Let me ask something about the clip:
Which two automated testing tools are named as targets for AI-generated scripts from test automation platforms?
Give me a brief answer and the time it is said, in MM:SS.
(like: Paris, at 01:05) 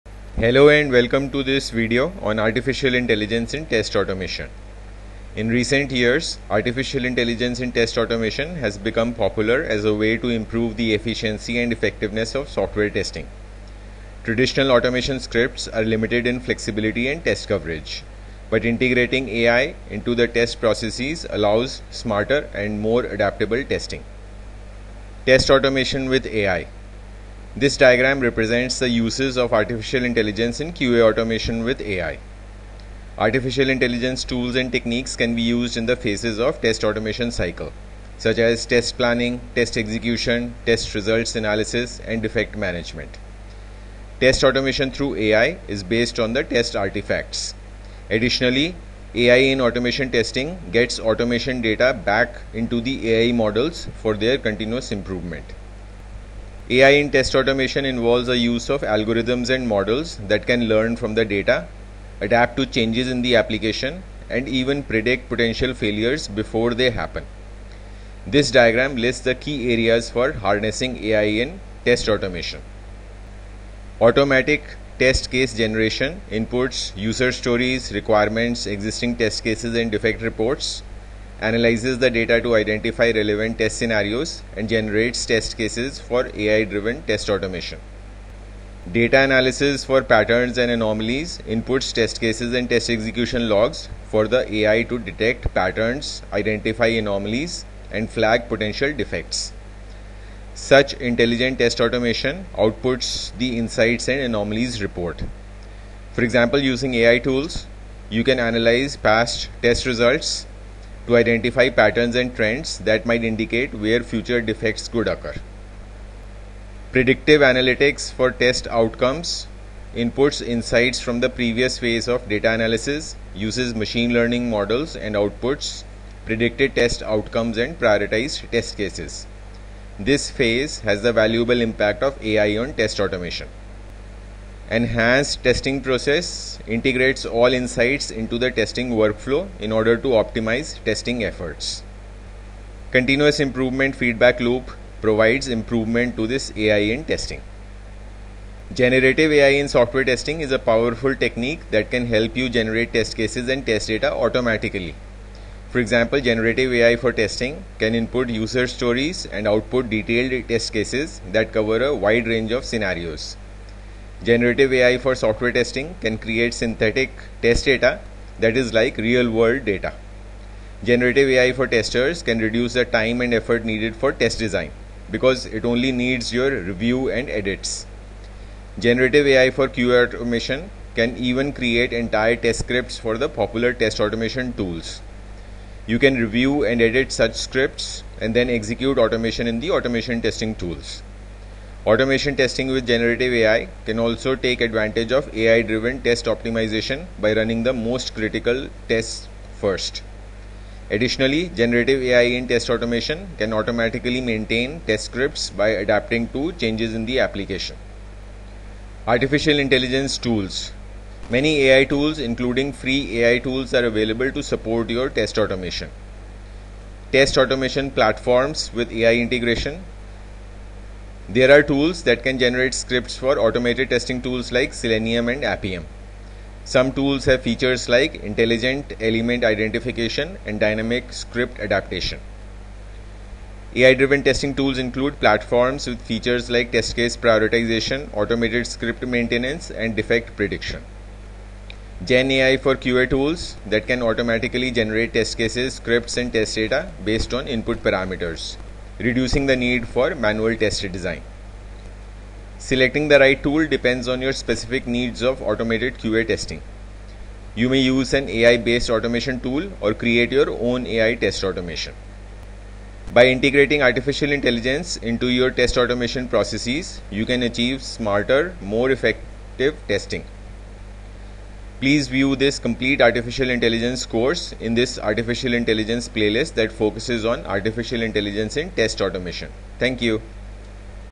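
Selenium and Appium, at 03:44.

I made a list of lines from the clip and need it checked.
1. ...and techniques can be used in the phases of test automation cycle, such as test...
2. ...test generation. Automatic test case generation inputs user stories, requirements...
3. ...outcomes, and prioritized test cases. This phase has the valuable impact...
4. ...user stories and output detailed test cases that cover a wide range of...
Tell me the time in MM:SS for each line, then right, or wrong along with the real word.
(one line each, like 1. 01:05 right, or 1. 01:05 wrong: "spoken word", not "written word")
1. 00:34 right
2. 01:11 wrong: "automation", not "generation"
3. 02:07 right
4. 02:38 right.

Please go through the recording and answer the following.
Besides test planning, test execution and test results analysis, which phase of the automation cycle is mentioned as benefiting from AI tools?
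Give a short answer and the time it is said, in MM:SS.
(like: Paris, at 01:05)
Defect management, at 00:42.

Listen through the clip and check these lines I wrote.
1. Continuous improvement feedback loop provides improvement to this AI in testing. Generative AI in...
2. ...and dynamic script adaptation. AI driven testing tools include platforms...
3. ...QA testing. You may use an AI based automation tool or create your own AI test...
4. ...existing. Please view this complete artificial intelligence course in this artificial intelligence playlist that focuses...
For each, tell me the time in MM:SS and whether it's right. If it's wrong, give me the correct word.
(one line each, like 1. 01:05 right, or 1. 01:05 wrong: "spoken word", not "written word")
1. 02:22 right
2. 03:50 right
3. 04:15 right
4. 04:29 wrong: "testing", not "existing".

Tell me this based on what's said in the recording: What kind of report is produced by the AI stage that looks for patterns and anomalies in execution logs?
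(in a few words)
Insights and anomalies report.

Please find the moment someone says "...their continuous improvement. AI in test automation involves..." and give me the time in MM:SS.
00:54.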